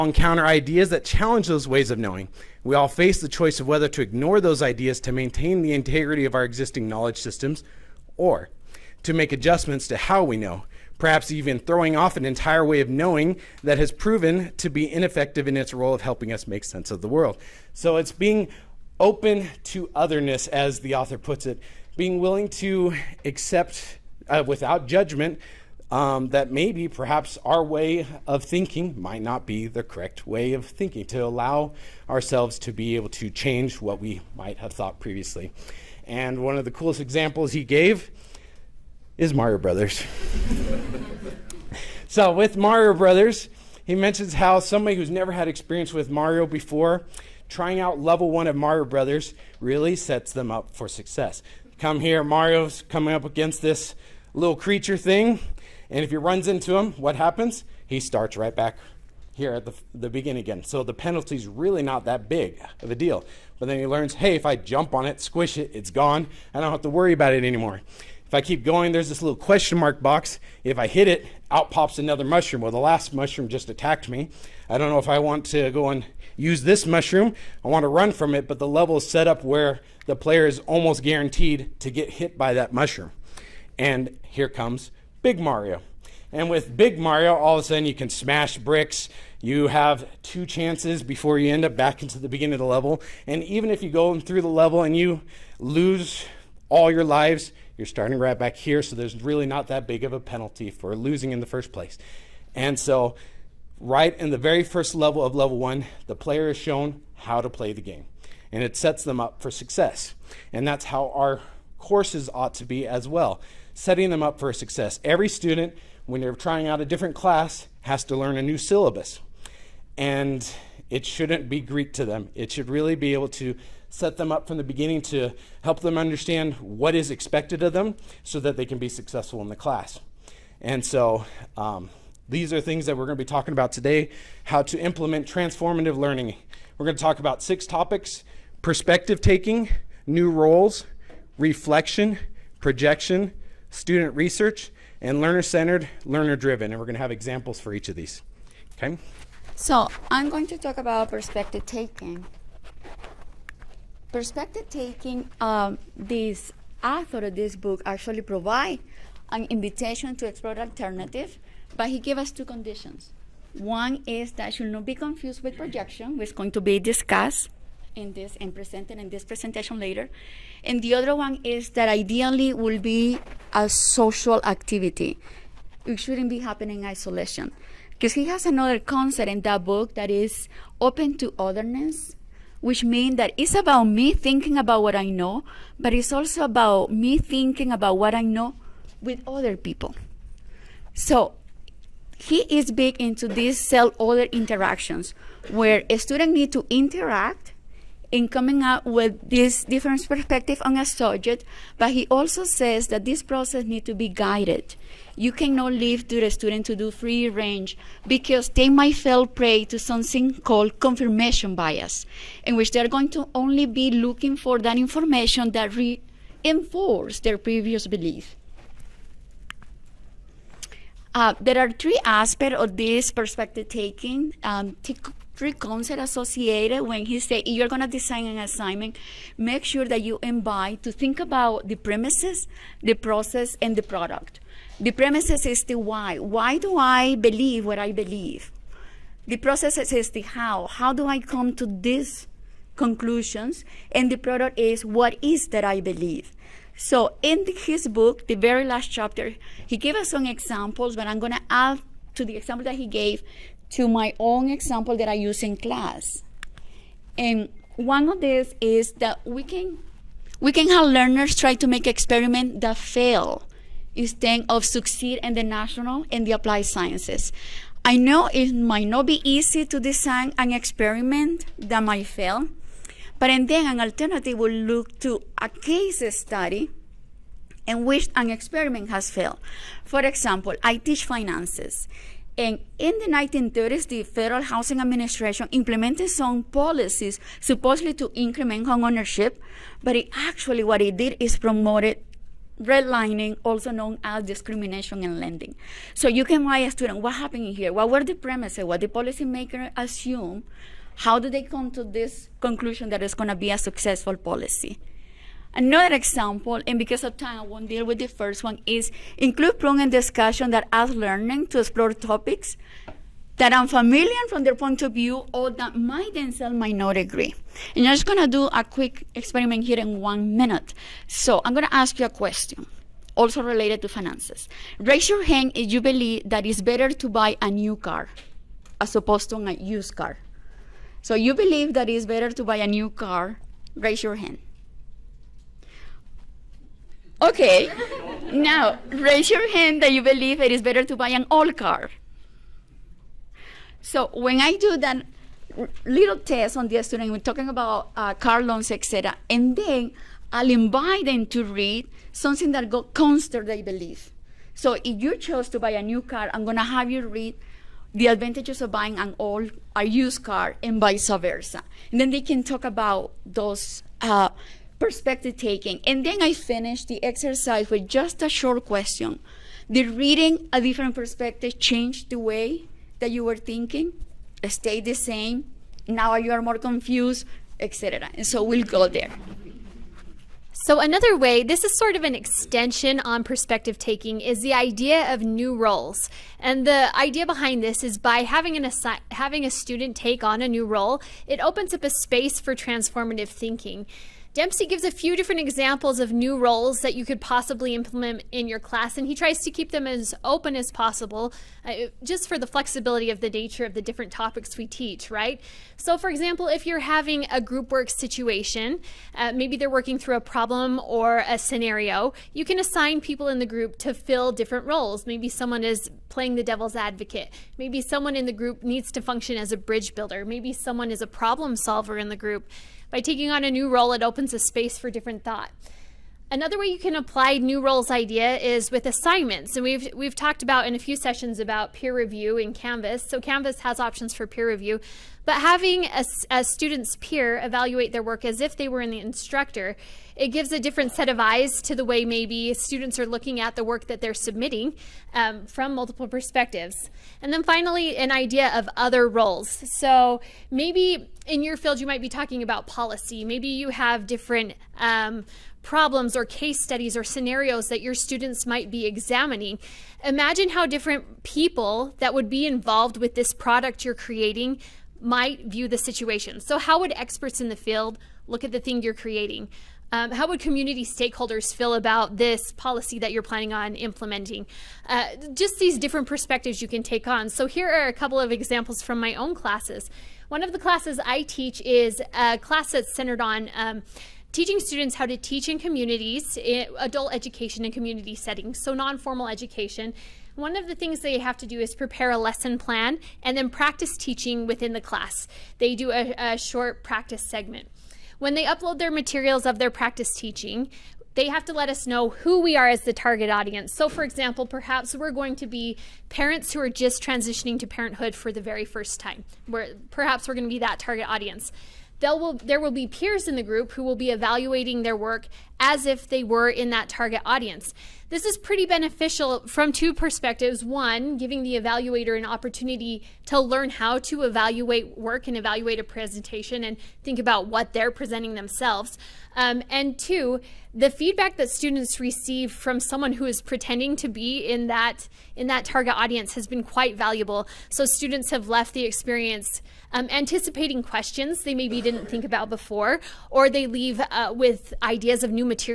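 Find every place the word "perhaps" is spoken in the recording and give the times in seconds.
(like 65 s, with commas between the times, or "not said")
10 s, 26 s, 504 s, 509 s.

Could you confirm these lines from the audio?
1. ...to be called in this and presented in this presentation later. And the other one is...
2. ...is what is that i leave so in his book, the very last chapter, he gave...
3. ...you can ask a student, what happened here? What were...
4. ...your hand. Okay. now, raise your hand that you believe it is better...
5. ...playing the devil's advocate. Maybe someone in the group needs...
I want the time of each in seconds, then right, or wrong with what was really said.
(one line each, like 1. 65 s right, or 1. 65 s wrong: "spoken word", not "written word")
1. 166 s wrong: "discussed", not "called"
2. 244 s wrong: "believe", not "leave"
3. 296 s right
4. 334 s right
5. 416 s right.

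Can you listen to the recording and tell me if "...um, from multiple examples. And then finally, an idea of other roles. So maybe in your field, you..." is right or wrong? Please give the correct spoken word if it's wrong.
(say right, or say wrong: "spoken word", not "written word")
wrong: "perspectives", not "examples".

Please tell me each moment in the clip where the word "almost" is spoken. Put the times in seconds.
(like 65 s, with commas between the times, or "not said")
80 s.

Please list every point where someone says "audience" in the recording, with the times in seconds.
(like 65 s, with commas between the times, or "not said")
503 s, 511 s, 517 s, 535 s.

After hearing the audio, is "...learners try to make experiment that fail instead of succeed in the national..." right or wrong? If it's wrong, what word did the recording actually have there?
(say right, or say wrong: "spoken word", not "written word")
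right.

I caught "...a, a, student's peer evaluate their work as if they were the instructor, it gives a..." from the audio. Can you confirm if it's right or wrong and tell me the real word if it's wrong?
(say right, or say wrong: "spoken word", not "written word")
right.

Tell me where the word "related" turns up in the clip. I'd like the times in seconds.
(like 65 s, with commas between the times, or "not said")
323 s.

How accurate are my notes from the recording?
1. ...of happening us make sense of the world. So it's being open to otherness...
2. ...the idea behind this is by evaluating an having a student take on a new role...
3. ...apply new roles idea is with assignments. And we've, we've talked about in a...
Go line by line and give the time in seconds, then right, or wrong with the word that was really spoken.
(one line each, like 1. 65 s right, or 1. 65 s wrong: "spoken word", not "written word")
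1. 15 s wrong: "helping", not "happening"
2. 386 s wrong: "having", not "evaluating"
3. 426 s right.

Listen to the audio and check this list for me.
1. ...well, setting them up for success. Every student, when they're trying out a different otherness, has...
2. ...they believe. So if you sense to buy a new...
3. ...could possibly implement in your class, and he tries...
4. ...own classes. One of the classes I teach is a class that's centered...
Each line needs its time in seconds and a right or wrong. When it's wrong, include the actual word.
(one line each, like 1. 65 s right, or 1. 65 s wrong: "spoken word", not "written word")
1. 113 s wrong: "class", not "otherness"
2. 353 s wrong: "chose", not "sense"
3. 397 s right
4. 479 s right.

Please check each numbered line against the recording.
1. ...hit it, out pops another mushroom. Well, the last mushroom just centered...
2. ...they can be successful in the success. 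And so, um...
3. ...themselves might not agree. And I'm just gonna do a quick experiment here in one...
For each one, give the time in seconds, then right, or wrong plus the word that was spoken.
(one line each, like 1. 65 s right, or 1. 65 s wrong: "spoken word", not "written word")
1. 70 s wrong: "attacked", not "centered"
2. 128 s wrong: "class", not "success"
3. 316 s right.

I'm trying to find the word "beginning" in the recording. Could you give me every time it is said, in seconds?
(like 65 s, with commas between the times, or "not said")
60 s, 92 s, 124 s.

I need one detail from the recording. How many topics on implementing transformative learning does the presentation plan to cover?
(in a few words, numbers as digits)
6.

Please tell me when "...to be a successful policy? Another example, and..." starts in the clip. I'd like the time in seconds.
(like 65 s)
303 s.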